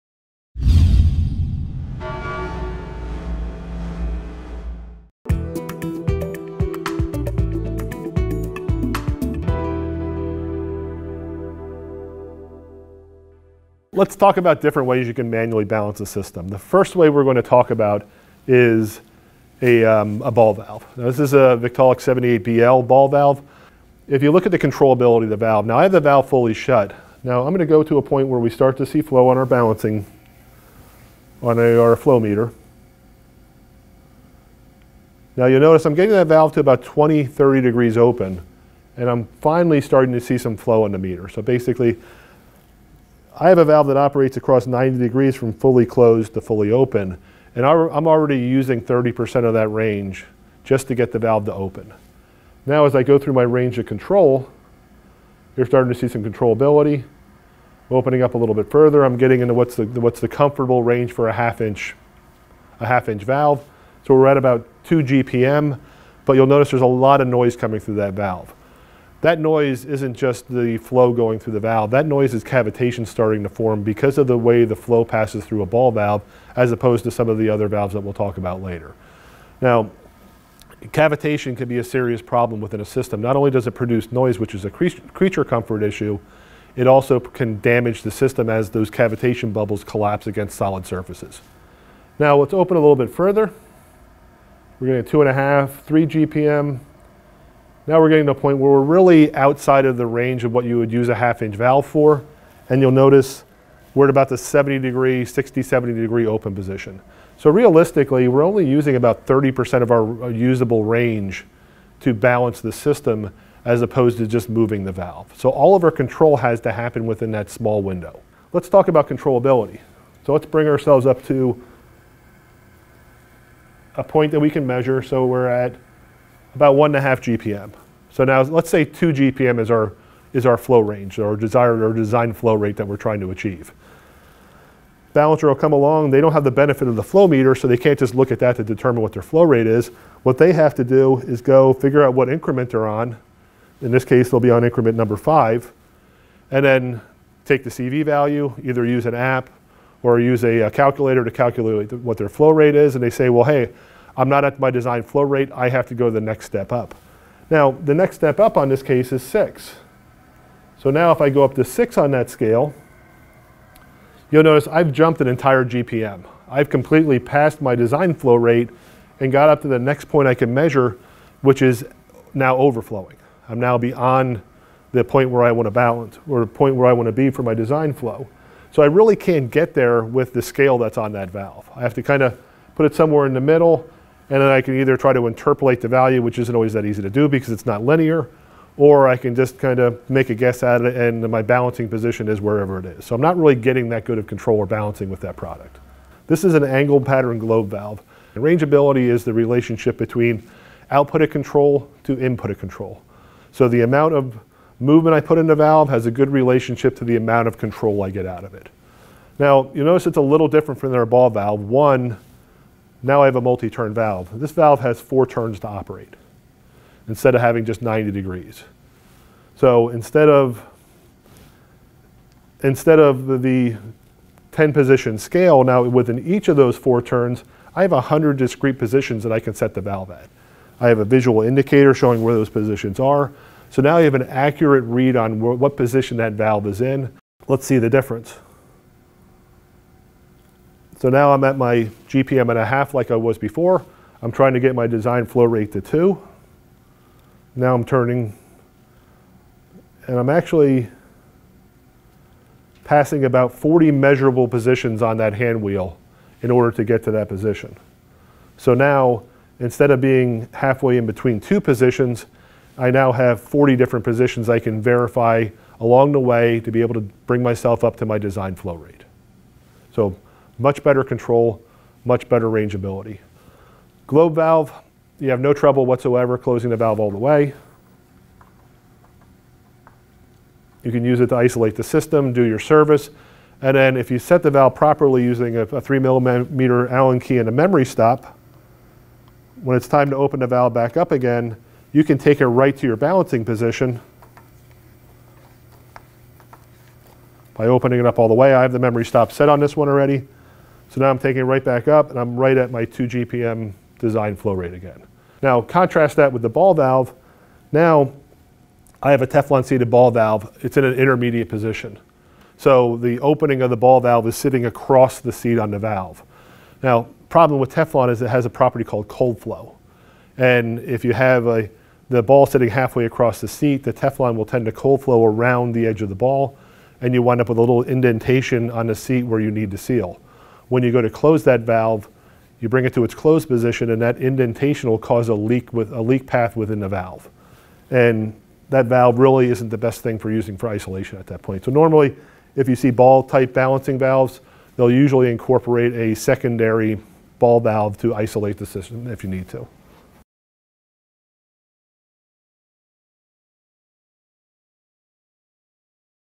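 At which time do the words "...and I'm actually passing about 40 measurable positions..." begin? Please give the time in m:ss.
4:10.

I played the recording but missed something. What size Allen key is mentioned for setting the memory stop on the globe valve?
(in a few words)
3 millimeter.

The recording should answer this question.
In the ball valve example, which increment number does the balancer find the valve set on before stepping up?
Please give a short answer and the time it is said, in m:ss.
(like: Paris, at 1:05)
5, at 2:25.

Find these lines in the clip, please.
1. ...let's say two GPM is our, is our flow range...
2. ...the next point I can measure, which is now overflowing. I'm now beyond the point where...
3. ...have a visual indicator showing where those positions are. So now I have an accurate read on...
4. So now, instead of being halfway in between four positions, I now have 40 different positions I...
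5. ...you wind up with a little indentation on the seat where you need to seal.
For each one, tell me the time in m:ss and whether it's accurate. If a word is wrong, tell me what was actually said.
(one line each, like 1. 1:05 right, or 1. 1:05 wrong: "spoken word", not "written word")
1. 2:08 right
2. 2:49 right
3. 3:50 right
4. 4:18 wrong: "two", not "four"
5. 5:27 right.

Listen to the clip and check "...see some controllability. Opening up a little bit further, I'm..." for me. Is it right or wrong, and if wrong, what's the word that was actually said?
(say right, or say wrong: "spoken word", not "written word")
right.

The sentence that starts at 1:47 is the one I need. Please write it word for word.
So realistically, we're only using about 30% of our usable range to balance the system as opposed to just moving the valve.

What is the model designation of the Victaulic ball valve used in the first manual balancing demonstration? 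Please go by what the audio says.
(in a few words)
78BL.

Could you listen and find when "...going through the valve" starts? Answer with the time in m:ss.
1:11.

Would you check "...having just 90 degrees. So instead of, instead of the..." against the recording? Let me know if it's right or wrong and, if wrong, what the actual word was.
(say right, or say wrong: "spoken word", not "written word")
right.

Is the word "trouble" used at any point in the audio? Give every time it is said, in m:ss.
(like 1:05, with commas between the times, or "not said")
4:35.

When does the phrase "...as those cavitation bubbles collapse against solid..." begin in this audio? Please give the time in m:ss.
1:28.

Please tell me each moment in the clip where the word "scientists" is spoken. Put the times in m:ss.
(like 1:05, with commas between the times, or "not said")
not said.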